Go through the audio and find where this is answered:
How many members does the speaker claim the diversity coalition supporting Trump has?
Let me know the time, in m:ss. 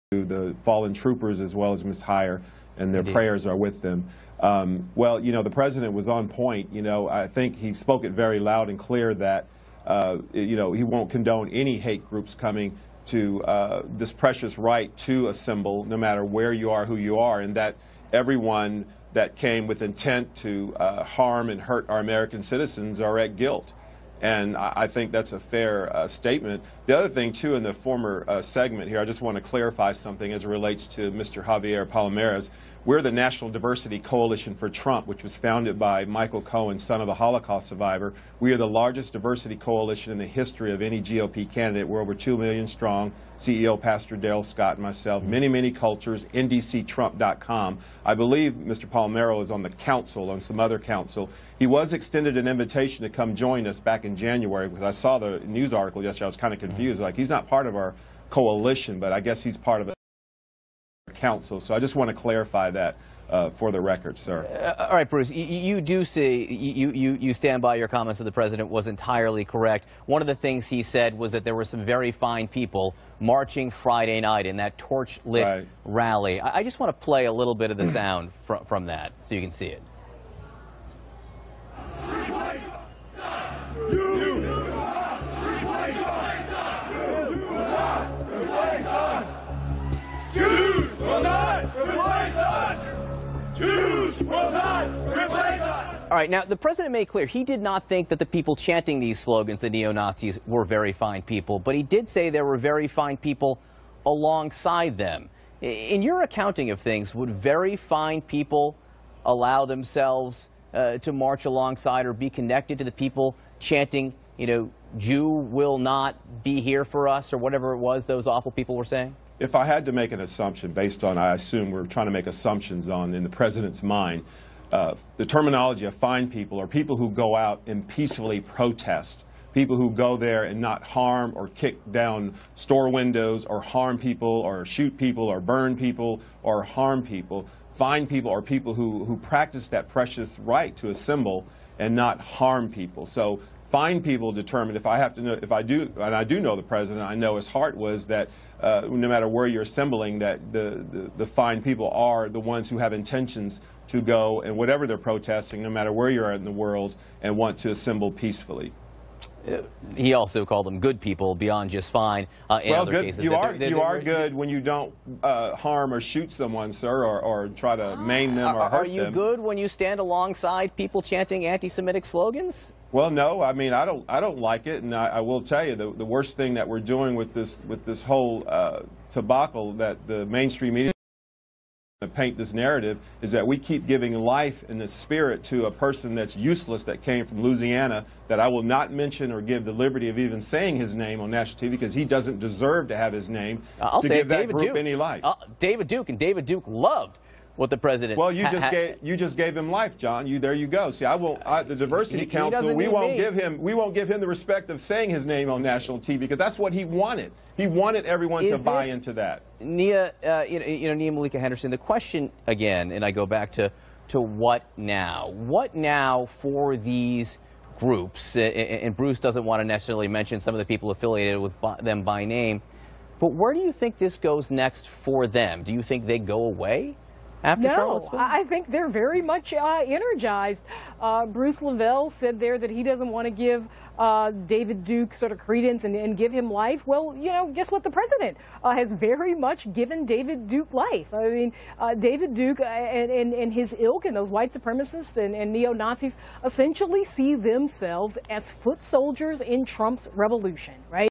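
0:42.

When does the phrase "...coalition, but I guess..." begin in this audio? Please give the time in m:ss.
0:58.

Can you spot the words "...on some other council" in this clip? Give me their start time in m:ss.
0:50.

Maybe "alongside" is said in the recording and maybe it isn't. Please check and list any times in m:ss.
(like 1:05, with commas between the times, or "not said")
1:44, 1:51, 2:49.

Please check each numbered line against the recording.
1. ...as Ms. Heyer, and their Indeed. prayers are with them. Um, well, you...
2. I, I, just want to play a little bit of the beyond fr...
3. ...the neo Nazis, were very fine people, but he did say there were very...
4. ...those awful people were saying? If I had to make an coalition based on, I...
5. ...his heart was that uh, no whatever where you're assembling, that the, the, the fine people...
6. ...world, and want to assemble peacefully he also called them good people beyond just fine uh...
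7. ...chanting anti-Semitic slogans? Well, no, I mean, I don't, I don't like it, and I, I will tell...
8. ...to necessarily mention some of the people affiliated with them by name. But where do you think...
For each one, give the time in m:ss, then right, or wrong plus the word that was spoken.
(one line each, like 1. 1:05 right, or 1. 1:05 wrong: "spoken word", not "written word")
1. 0:01 right
2. 1:16 wrong: "sound", not "beyond"
3. 1:39 right
4. 1:58 wrong: "assumption", not "coalition"
5. 2:27 wrong: "matter", not "whatever"
6. 2:36 right
7. 2:51 right
8. 3:39 right.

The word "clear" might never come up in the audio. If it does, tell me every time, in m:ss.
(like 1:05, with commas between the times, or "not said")
0:08, 1:37.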